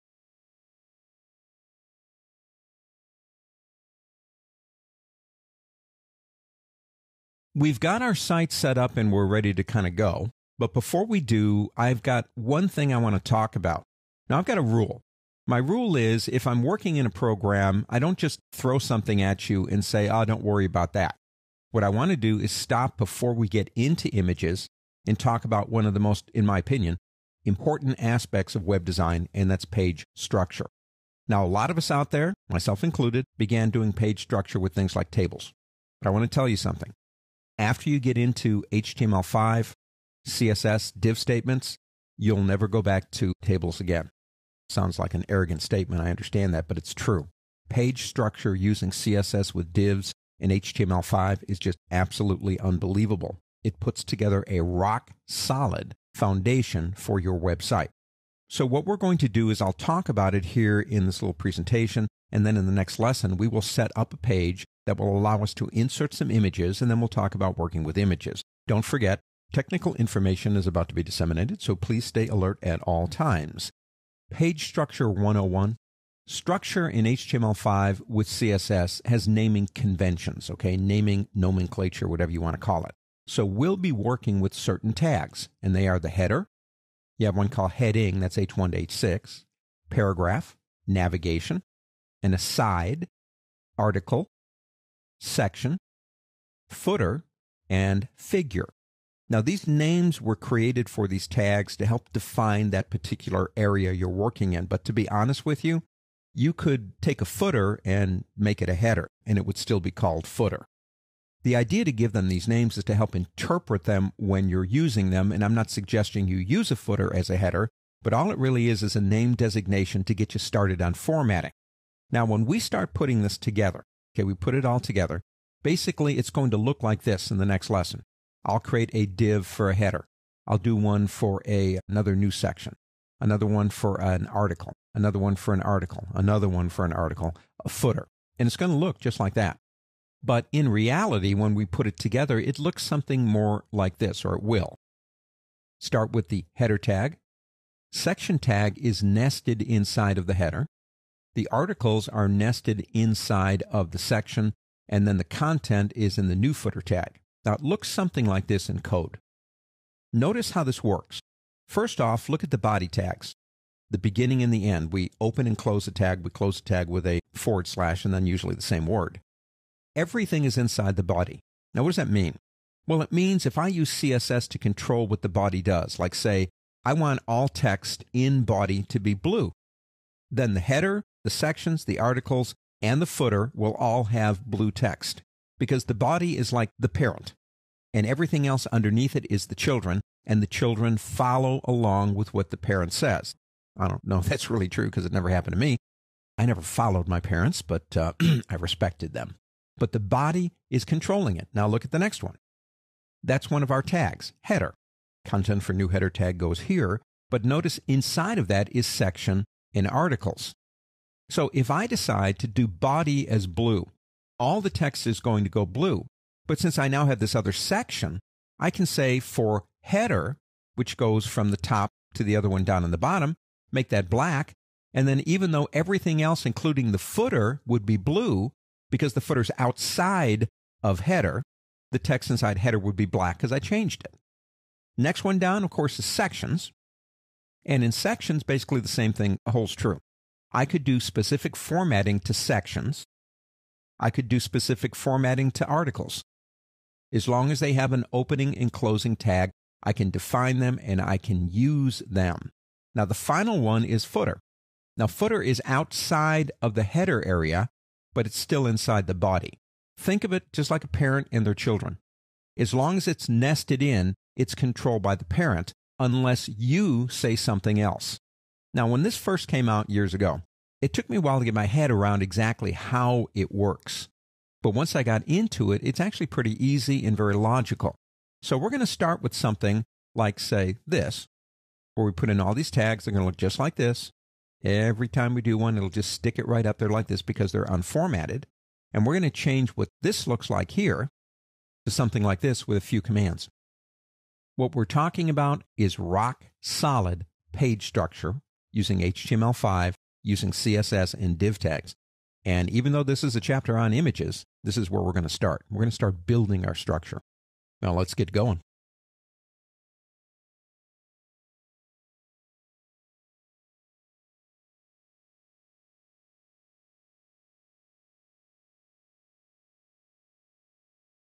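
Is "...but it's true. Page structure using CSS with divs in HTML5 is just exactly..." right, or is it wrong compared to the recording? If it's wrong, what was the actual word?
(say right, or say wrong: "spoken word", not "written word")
wrong: "absolutely", not "exactly".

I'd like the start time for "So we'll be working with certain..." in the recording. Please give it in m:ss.
1:23.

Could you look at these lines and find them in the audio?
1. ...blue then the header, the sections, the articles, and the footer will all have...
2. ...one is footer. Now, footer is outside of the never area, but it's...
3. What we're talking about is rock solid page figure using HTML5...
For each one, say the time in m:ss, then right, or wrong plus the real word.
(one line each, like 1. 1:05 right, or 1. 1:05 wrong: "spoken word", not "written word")
1. 2:59 right
2. 4:13 wrong: "header", not "never"
3. 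4:54 wrong: "structure", not "figure".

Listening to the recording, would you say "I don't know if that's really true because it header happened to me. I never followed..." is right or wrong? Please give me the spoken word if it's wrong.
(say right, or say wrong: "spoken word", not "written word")
wrong: "never", not "header".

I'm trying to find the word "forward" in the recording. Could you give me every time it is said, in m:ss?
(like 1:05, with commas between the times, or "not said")
2:47.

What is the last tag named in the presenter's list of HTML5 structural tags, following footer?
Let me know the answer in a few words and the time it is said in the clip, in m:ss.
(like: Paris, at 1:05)
figure, at 1:38.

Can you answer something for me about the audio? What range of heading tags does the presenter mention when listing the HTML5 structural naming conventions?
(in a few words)
H1 to H6.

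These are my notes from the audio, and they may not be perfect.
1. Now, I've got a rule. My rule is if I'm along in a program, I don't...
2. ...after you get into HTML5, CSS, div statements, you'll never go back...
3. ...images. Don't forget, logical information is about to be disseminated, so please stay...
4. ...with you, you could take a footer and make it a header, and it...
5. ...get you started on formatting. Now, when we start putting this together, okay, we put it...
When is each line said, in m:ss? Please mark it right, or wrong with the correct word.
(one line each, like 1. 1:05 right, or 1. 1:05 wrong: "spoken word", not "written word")
1. 0:14 wrong: "working", not "along"
2. 0:37 right
3. 1:07 wrong: "technical", not "logical"
4. 1:45 right
5. 2:00 right.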